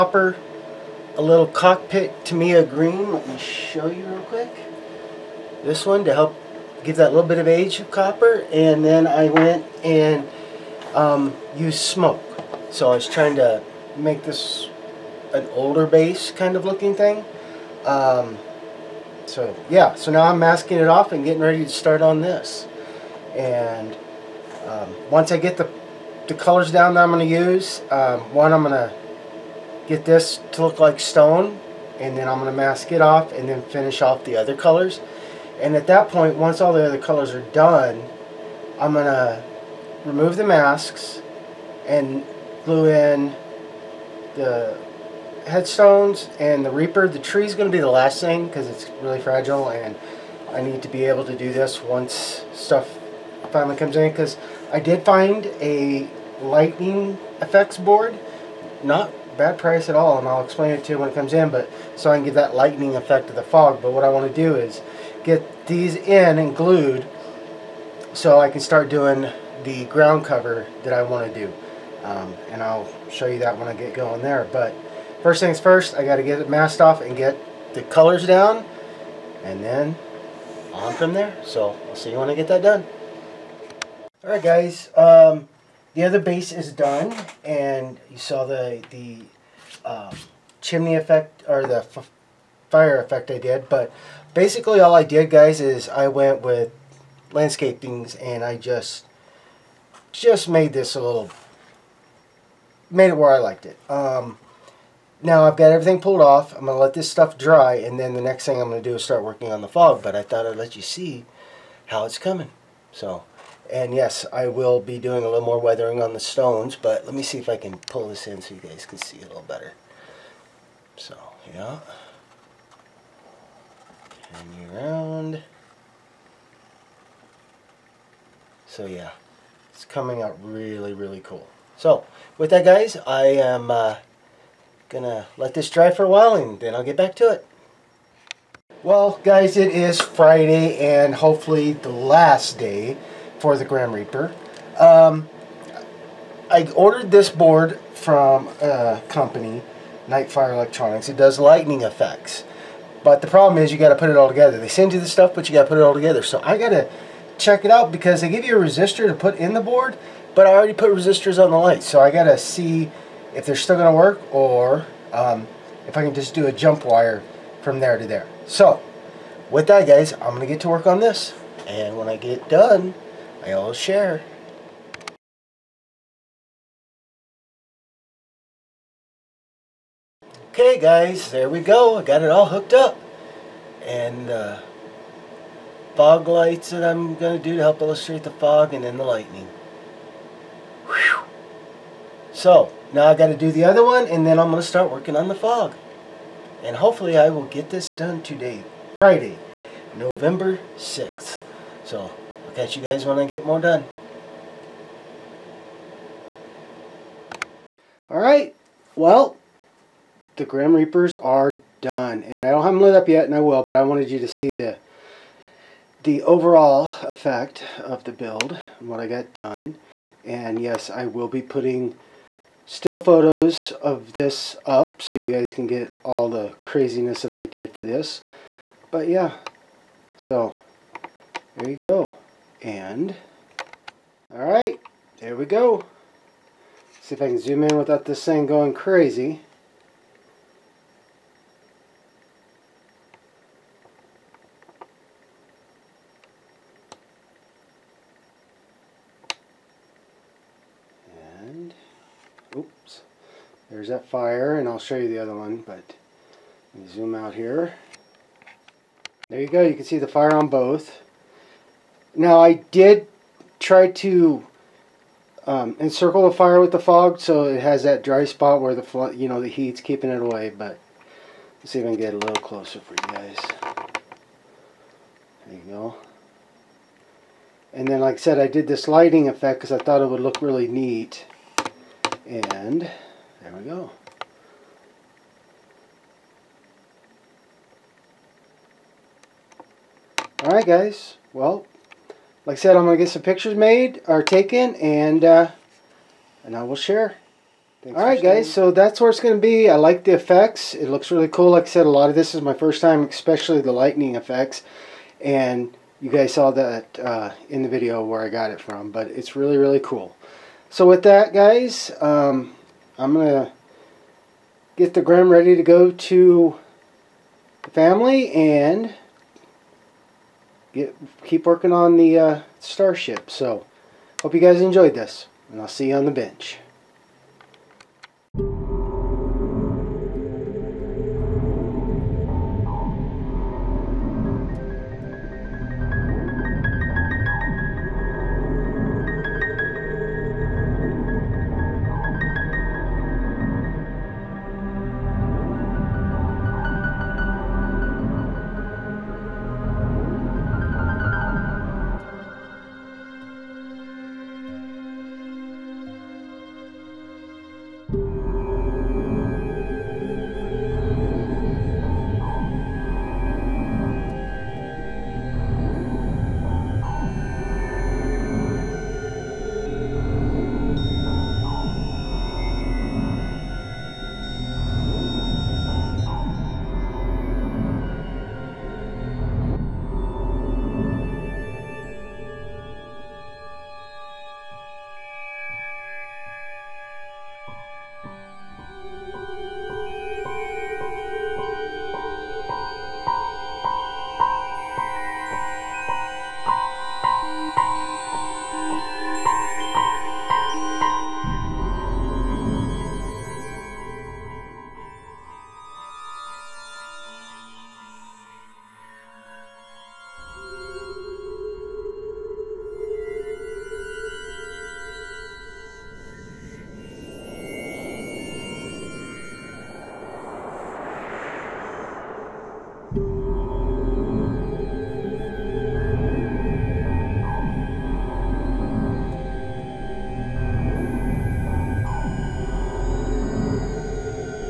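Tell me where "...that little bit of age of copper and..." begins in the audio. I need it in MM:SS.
00:06.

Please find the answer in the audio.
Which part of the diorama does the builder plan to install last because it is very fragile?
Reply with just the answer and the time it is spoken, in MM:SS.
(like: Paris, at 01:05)
The tree, at 00:47.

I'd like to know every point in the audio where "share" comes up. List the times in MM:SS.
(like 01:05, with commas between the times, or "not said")
02:53, 04:56.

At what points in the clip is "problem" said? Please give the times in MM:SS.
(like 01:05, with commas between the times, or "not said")
02:33.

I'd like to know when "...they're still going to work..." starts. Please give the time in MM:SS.
02:43.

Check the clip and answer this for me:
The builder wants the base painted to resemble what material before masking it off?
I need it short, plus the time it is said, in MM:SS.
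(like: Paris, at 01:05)
Stone, at 00:30.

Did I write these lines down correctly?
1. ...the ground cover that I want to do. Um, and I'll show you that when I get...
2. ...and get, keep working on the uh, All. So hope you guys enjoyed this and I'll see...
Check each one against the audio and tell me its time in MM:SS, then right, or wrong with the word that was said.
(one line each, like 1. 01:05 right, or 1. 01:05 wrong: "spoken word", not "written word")
1. 01:09 right
2. 05:18 wrong: "Starship", not "All".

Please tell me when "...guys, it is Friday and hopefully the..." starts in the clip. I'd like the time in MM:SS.
02:19.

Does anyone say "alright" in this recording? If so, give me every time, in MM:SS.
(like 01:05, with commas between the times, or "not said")
03:28, 03:54, 04:50.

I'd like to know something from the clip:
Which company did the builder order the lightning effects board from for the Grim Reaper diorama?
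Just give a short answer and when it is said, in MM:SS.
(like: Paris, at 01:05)
Nightfire Electronics, at 02:30.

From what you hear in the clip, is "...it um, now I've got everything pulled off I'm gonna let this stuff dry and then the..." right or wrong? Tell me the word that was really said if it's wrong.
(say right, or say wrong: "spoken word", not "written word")
right.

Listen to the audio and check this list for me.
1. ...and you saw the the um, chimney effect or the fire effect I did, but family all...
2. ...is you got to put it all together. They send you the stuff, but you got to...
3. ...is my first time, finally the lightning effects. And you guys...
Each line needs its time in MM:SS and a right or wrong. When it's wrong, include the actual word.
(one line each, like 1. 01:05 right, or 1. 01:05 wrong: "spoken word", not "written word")
1. 01:27 wrong: "basically", not "family"
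2. 02:33 right
3. 05:02 wrong: "especially", not "finally".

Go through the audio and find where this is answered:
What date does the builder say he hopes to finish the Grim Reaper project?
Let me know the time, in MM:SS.
03:19.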